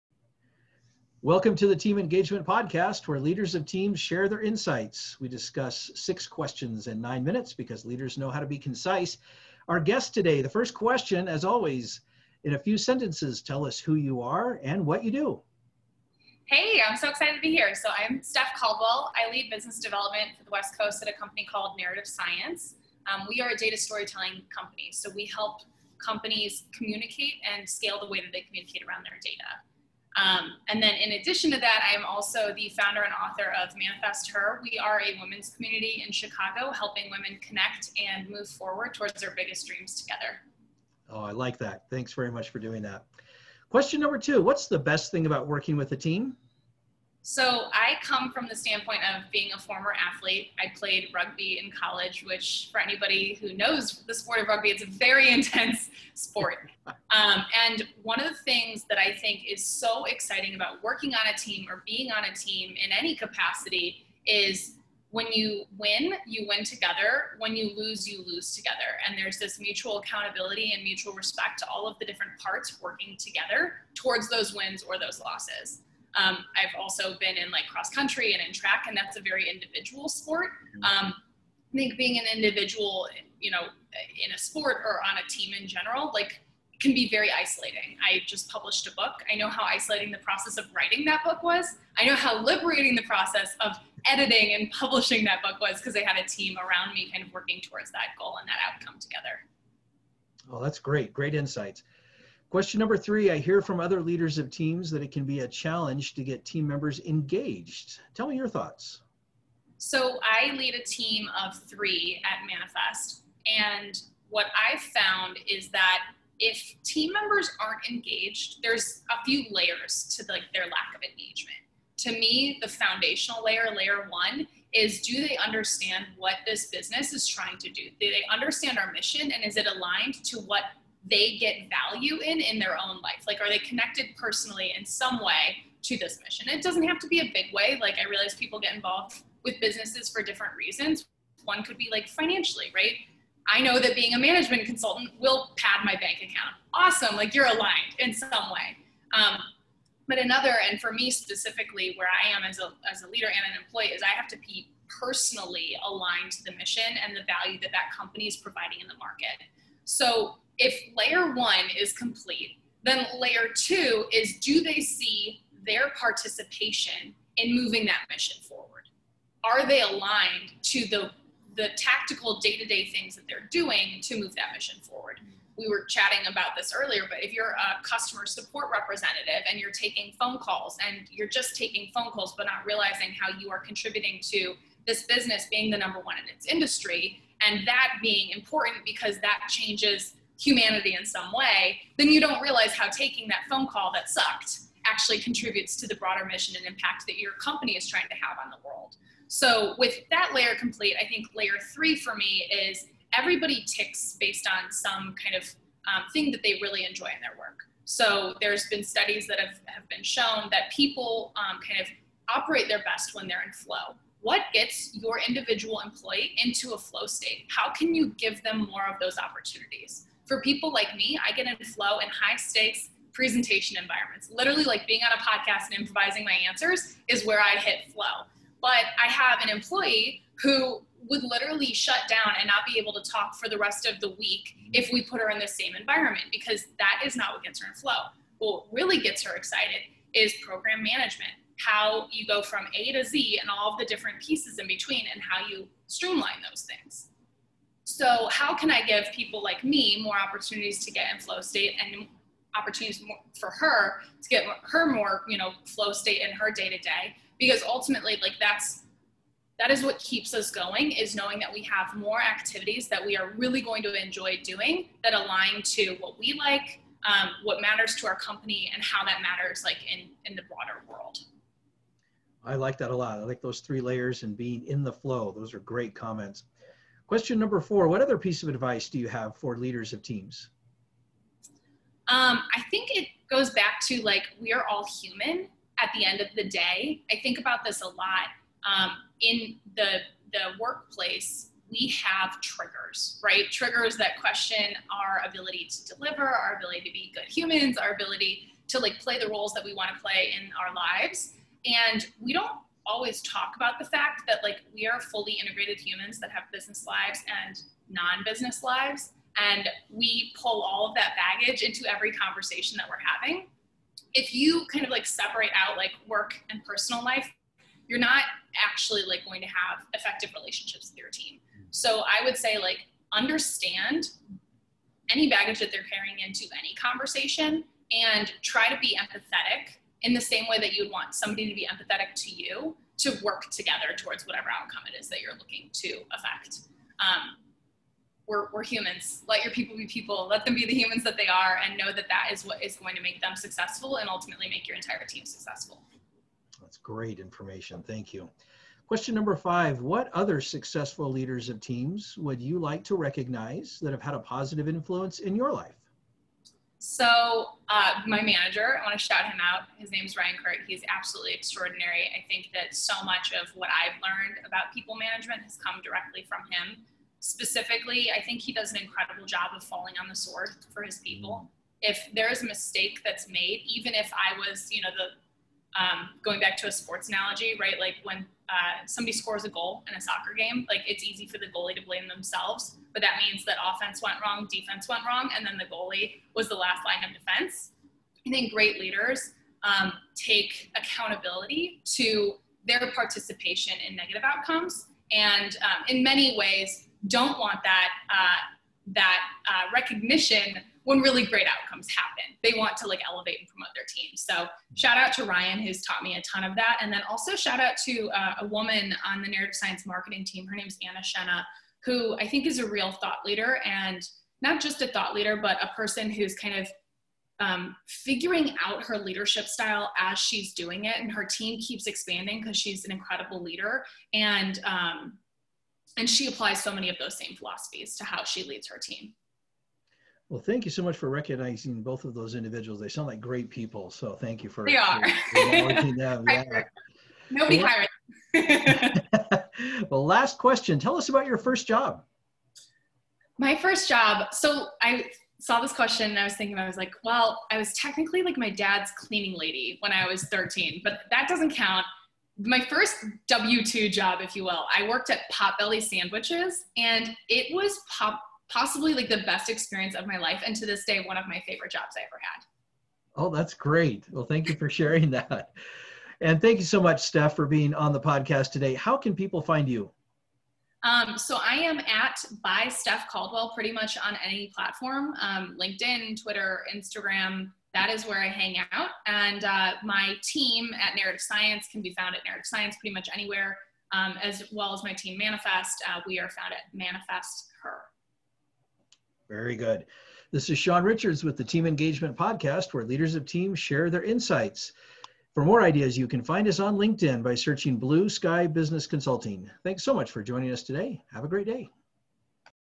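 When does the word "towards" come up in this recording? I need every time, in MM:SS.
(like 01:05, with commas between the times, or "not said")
00:38, 01:13, 01:37, 05:33.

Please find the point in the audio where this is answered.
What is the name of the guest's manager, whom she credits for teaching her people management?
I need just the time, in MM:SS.
06:00.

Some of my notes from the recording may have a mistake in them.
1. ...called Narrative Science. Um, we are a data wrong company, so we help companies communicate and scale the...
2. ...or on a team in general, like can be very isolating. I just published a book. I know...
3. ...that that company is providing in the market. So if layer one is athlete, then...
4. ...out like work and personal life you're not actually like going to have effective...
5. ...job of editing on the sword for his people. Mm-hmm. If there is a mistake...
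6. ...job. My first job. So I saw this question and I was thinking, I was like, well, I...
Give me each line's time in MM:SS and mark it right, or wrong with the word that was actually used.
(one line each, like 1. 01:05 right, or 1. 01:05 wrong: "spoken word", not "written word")
1. 00:21 wrong: "storytelling", not "wrong"
2. 01:24 right
3. 02:37 wrong: "complete", not "athlete"
4. 05:15 right
5. 06:09 wrong: "falling", not "editing"
6. 07:21 right.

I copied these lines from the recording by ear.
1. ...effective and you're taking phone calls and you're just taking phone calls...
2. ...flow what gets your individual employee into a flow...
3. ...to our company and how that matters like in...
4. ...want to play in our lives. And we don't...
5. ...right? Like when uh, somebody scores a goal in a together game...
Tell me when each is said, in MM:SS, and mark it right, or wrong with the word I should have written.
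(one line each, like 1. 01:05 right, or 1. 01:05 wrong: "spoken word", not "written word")
1. 02:58 wrong: "representative", not "effective"
2. 03:33 right
3. 04:27 right
4. 04:59 right
5. 06:17 wrong: "soccer", not "together".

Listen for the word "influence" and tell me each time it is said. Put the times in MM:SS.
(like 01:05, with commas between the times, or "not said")
05:54.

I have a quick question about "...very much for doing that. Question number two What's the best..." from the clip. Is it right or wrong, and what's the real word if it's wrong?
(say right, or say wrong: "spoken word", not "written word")
right.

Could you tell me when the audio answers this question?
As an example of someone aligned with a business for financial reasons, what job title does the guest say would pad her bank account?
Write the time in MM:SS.
02:24.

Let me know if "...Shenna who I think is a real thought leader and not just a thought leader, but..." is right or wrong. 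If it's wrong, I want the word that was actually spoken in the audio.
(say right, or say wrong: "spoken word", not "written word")
right.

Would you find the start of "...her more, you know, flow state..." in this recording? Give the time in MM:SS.
04:14.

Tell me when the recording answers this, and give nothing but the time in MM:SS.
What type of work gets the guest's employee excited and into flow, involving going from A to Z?
04:00.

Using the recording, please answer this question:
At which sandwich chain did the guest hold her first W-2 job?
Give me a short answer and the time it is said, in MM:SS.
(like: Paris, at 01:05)
Potbelly Sandwiches, at 07:35.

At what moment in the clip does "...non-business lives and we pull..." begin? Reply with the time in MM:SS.
05:07.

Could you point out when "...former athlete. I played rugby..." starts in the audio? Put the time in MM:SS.
00:49.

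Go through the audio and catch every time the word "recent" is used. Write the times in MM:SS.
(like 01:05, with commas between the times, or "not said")
not said.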